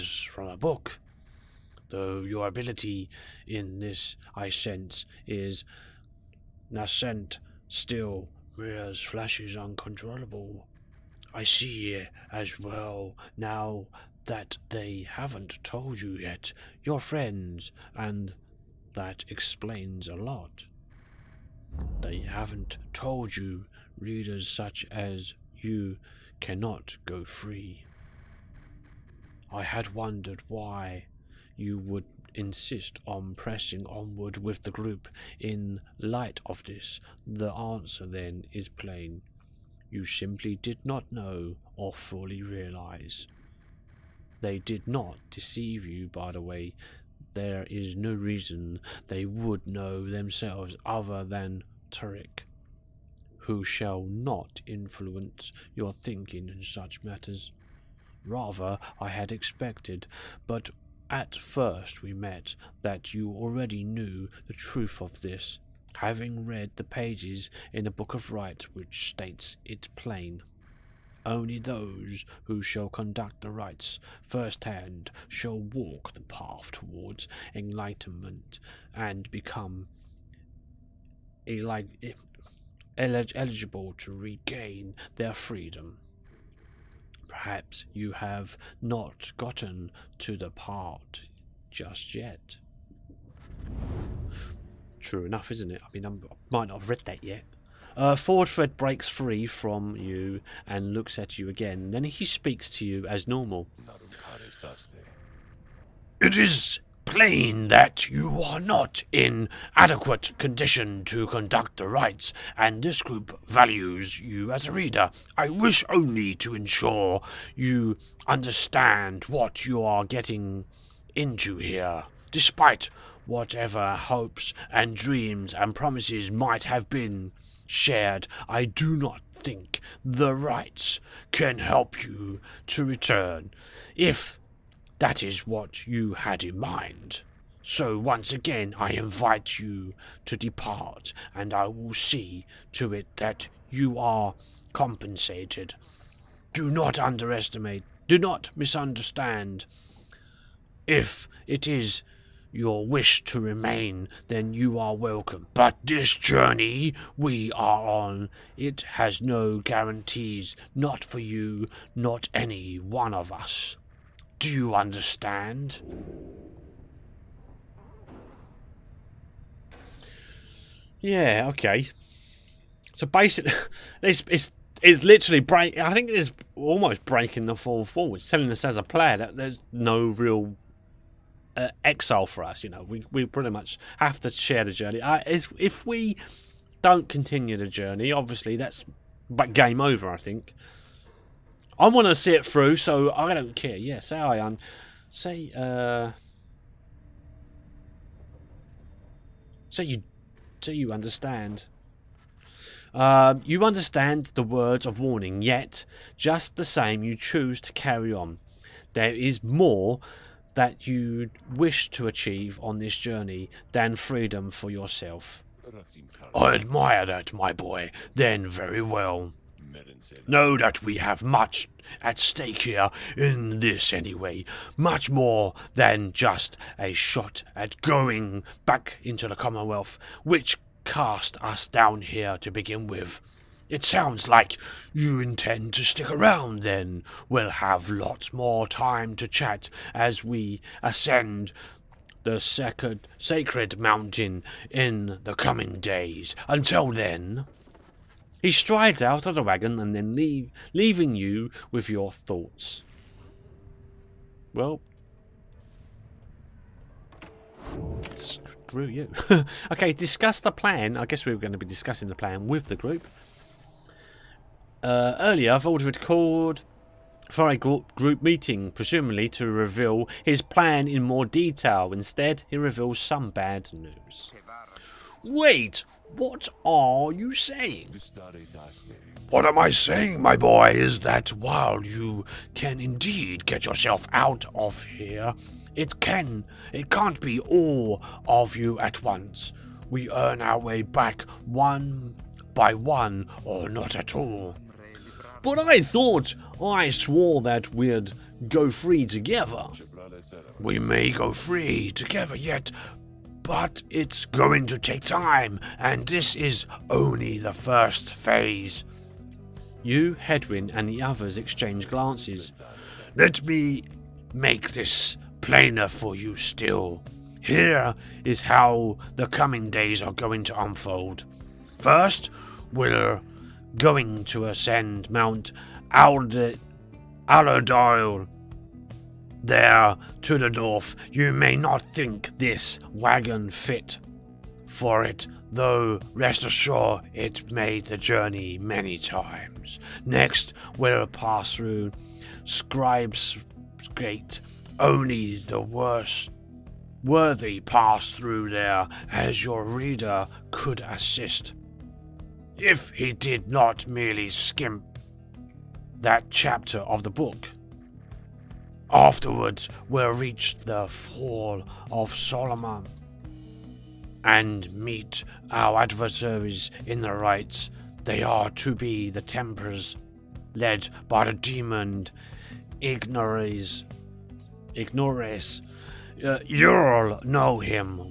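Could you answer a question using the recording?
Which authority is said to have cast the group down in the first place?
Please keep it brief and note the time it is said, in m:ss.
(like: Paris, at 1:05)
the Commonwealth, at 3:49.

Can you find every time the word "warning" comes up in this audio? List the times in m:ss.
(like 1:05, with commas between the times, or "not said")
3:24.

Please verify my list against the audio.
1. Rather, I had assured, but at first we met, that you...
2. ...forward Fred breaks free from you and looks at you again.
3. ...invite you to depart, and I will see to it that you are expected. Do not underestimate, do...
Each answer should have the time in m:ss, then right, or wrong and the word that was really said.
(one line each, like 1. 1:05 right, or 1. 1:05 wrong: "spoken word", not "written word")
1. 0:58 wrong: "expected", not "assured"
2. 1:38 right
3. 2:18 wrong: "compensated", not "expected".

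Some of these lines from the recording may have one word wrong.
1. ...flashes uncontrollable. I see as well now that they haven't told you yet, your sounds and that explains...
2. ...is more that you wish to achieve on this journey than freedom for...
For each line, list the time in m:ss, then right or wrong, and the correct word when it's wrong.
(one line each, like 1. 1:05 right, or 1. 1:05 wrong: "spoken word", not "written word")
1. 0:09 wrong: "friends", not "sounds"
2. 3:29 right.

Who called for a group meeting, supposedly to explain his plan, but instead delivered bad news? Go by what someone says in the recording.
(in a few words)
Vold.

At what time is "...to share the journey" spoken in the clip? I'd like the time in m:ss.
3:04.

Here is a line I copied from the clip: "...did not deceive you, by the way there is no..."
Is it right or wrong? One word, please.
right.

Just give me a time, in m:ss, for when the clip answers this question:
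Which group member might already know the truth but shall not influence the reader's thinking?
0:51.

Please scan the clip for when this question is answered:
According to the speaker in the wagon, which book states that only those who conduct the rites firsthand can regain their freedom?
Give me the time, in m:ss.
1:07.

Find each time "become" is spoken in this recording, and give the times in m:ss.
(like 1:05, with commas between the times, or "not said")
1:19.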